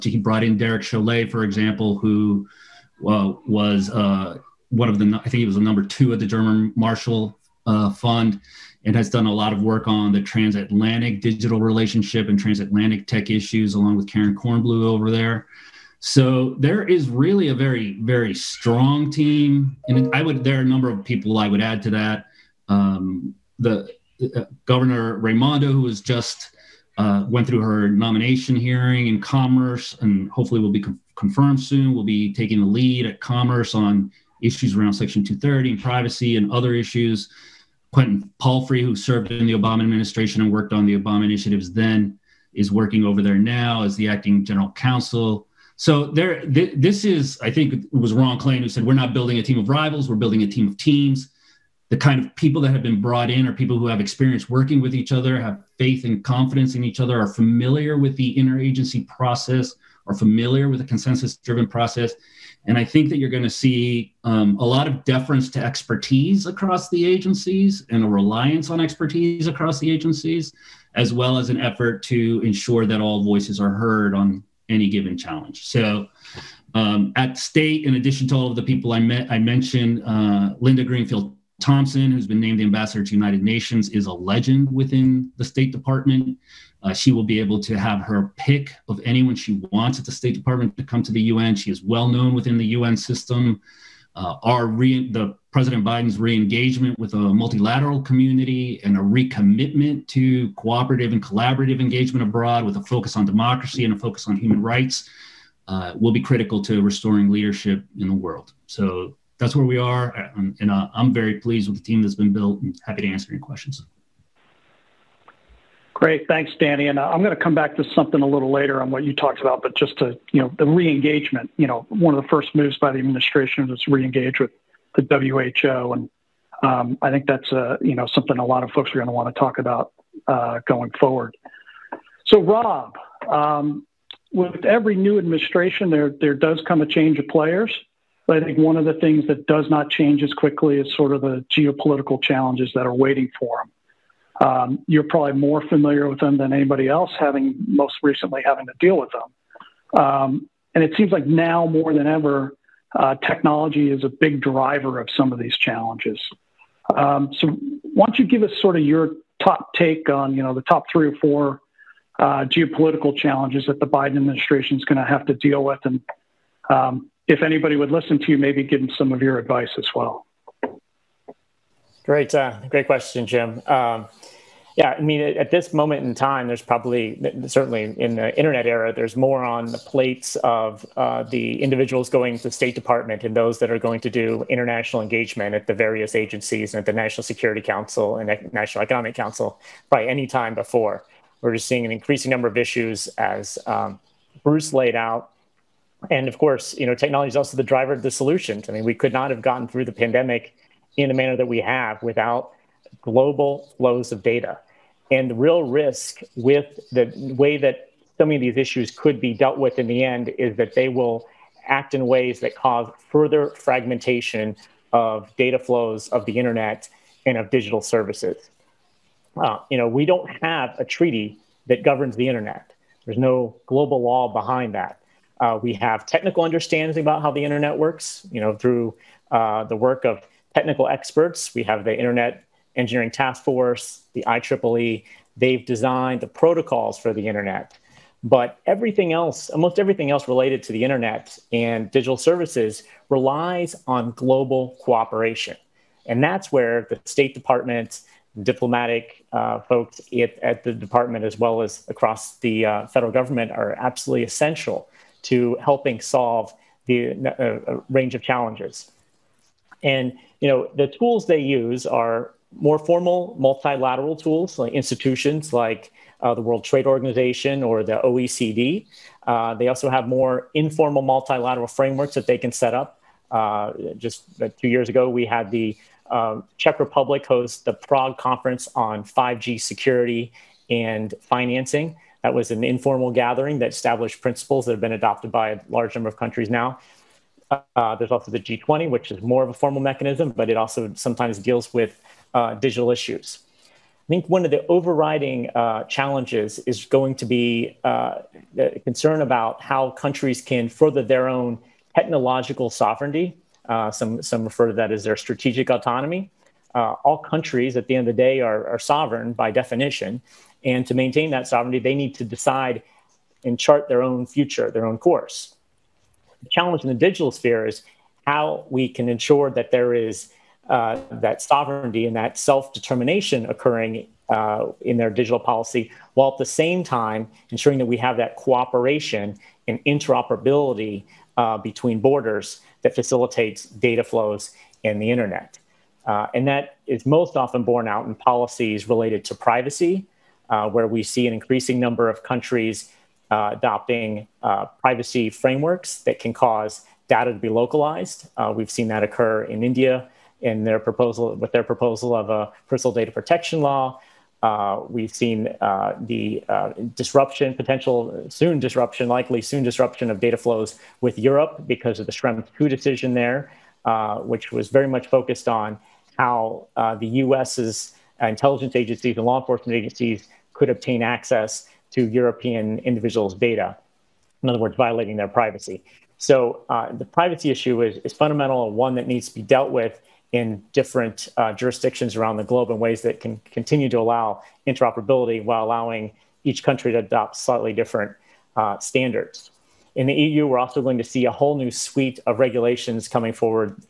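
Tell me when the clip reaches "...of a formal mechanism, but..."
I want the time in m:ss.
4:49.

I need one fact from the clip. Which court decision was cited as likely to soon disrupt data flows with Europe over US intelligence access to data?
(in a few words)
Schrems 2.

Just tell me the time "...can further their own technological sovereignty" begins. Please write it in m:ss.
5:00.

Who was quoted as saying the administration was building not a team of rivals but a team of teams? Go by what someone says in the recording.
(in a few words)
Ron Klain.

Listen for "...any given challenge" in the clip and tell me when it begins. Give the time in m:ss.
1:14.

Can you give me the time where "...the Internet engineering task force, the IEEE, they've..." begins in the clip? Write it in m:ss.
3:51.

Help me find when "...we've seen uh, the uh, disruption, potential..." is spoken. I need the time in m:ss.
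5:54.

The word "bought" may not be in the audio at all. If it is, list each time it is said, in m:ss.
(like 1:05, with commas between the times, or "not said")
not said.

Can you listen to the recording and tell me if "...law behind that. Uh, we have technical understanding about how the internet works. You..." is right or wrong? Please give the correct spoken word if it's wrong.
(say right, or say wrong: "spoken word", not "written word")
right.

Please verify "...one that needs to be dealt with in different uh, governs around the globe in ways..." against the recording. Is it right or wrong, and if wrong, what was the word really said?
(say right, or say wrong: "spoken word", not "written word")
wrong: "jurisdictions", not "governs".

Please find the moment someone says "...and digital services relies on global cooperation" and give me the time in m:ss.
4:01.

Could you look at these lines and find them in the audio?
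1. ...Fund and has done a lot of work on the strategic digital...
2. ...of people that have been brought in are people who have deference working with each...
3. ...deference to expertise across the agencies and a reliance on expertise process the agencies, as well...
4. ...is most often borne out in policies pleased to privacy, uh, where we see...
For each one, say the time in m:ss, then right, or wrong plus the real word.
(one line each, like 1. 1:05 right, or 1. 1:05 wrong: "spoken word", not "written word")
1. 0:07 wrong: "transatlantic", not "strategic"
2. 0:52 wrong: "experience", not "deference"
3. 1:05 wrong: "across", not "process"
4. 5:36 wrong: "related", not "pleased".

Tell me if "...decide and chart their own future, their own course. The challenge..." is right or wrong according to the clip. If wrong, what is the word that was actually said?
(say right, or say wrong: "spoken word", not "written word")
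right.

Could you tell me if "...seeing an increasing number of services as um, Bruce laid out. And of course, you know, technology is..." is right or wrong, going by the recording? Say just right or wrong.
wrong.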